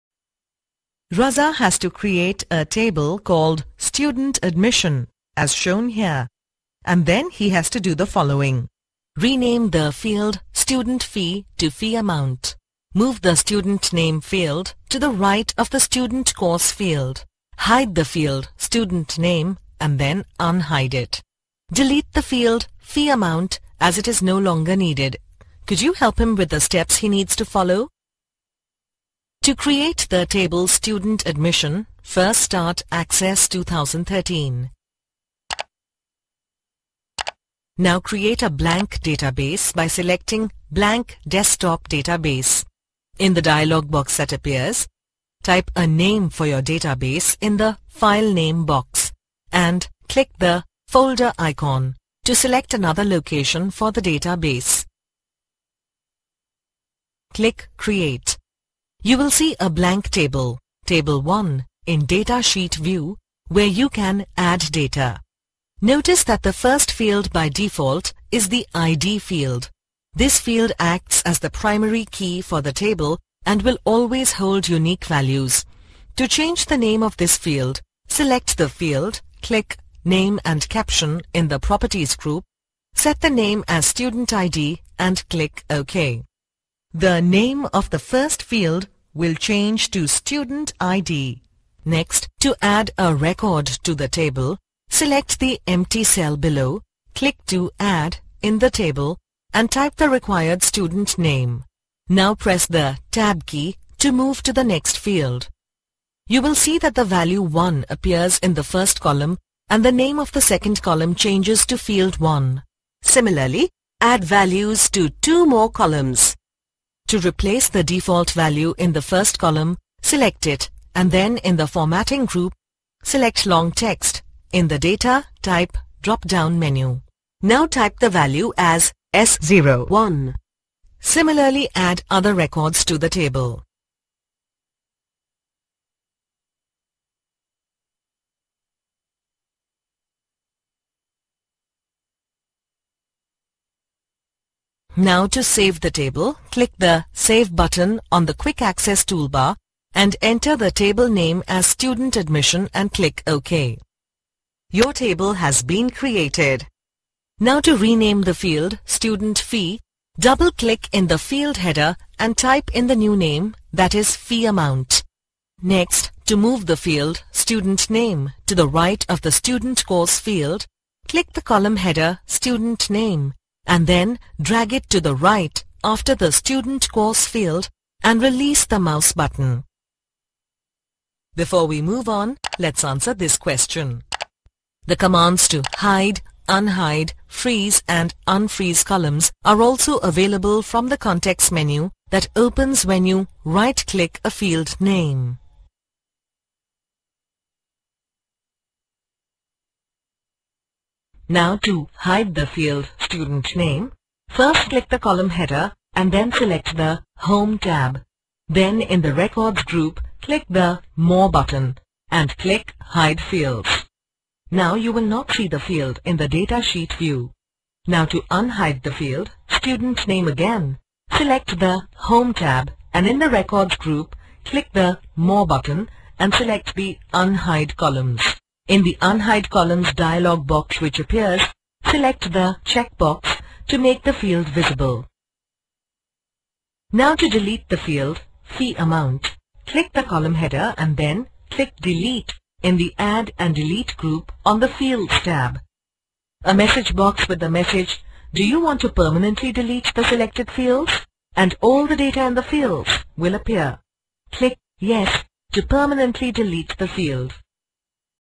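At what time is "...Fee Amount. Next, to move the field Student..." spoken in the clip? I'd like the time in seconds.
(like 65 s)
164 s.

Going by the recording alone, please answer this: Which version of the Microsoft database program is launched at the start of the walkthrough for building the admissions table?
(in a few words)
Access 2013.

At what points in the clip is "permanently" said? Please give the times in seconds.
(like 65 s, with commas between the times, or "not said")
248 s, 255 s.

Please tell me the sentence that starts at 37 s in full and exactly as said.
Now create a blank database by selecting Blank Desktop Database.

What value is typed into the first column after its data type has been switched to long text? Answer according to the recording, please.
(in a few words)
S01.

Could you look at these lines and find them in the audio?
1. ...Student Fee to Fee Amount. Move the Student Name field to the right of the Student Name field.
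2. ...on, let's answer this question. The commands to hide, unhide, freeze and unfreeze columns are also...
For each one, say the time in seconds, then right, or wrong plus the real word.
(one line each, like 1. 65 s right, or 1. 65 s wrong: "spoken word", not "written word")
1. 10 s wrong: "Course", not "Name"
2. 182 s right.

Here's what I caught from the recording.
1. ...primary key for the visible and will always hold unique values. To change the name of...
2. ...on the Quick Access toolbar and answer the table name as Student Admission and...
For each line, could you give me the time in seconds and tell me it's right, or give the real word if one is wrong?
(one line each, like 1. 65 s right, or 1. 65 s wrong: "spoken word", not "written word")
1. 71 s wrong: "table", not "visible"
2. 148 s wrong: "enter", not "answer".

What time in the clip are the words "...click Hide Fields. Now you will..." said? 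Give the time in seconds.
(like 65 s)
212 s.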